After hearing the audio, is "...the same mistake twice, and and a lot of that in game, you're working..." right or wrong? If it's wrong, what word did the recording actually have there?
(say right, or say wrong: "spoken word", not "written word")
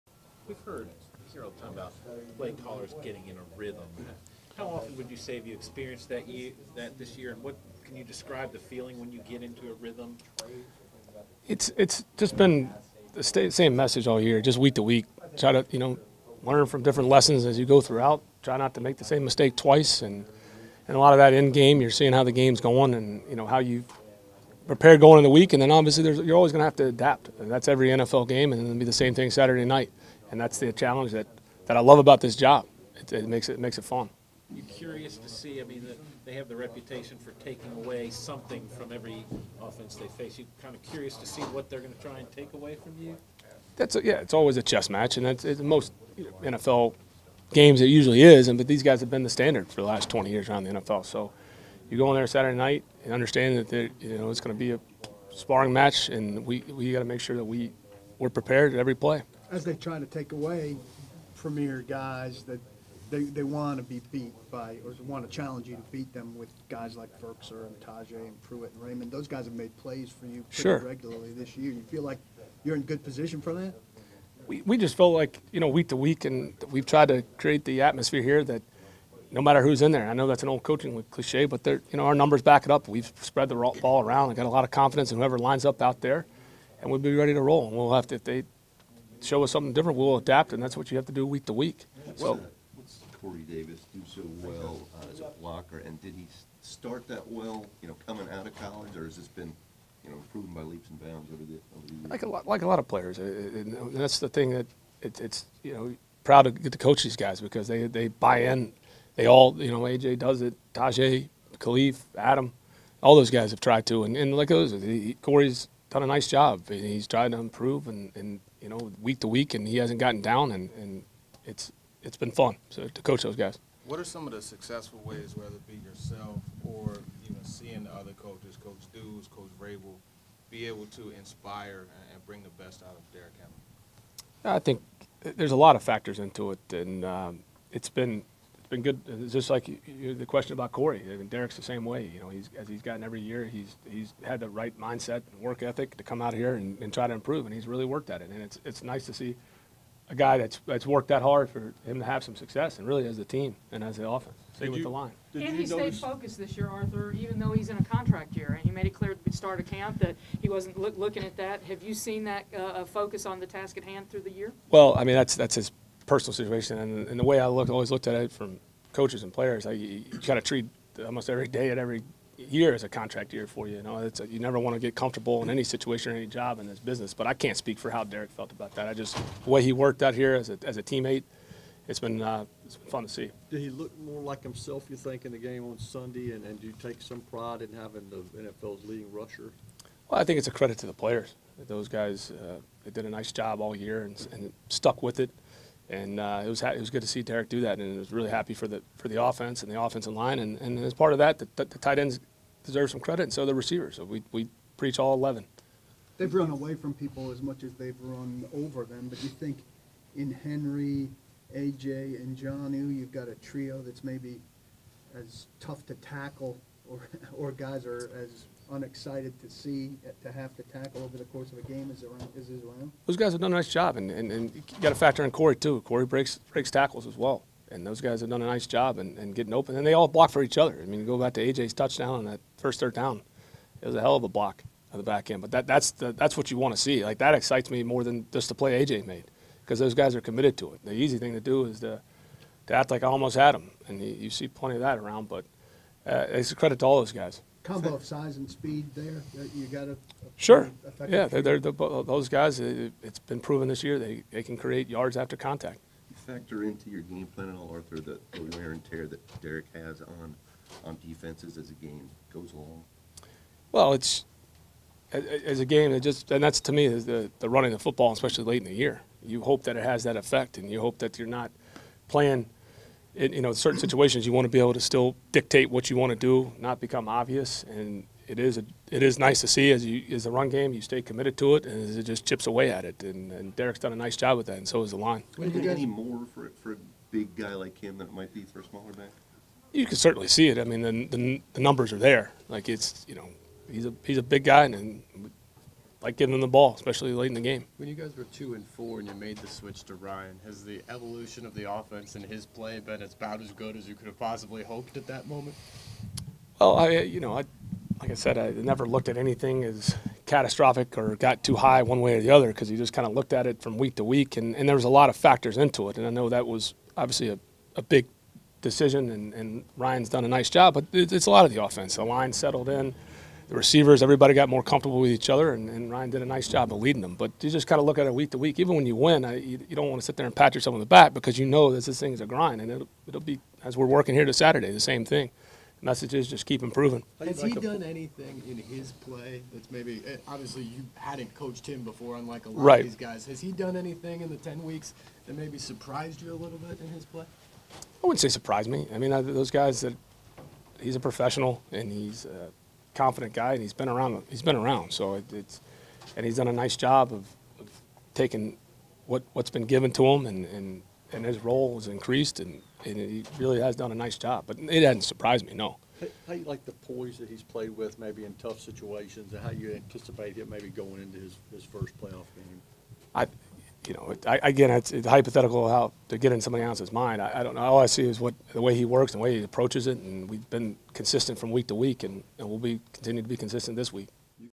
wrong: "seeing", not "working".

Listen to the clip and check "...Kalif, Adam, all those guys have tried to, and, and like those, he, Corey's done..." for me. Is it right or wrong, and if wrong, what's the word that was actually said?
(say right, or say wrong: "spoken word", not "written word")
right.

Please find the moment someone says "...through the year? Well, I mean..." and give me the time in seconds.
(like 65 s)
164 s.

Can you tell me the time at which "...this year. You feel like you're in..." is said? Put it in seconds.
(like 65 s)
71 s.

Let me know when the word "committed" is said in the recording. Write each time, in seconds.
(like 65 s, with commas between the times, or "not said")
240 s, 281 s.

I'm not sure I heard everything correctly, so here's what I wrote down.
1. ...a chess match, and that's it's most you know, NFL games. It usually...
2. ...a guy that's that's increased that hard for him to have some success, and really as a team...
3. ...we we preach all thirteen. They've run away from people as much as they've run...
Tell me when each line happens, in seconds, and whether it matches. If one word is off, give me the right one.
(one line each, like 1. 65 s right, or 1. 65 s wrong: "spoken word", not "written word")
1. 44 s right
2. 150 s wrong: "worked", not "increased"
3. 204 s wrong: "eleven", not "thirteen".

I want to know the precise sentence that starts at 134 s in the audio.
I think there's a lot of factors into it, and um, it's been been good.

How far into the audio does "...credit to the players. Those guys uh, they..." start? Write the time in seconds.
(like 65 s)
190 s.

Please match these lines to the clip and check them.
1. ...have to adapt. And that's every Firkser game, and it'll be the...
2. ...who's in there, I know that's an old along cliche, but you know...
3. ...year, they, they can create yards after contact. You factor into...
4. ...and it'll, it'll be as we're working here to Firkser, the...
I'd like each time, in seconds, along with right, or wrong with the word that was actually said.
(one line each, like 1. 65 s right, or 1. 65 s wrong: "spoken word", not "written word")
1. 26 s wrong: "NFL", not "Firkser"
2. 79 s wrong: "coaching", not "along"
3. 253 s right
4. 332 s wrong: "Saturday", not "Firkser".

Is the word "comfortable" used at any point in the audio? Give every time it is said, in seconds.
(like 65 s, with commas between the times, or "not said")
174 s, 324 s.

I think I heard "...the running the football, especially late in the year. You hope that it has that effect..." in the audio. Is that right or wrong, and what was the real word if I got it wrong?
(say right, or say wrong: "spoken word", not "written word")
right.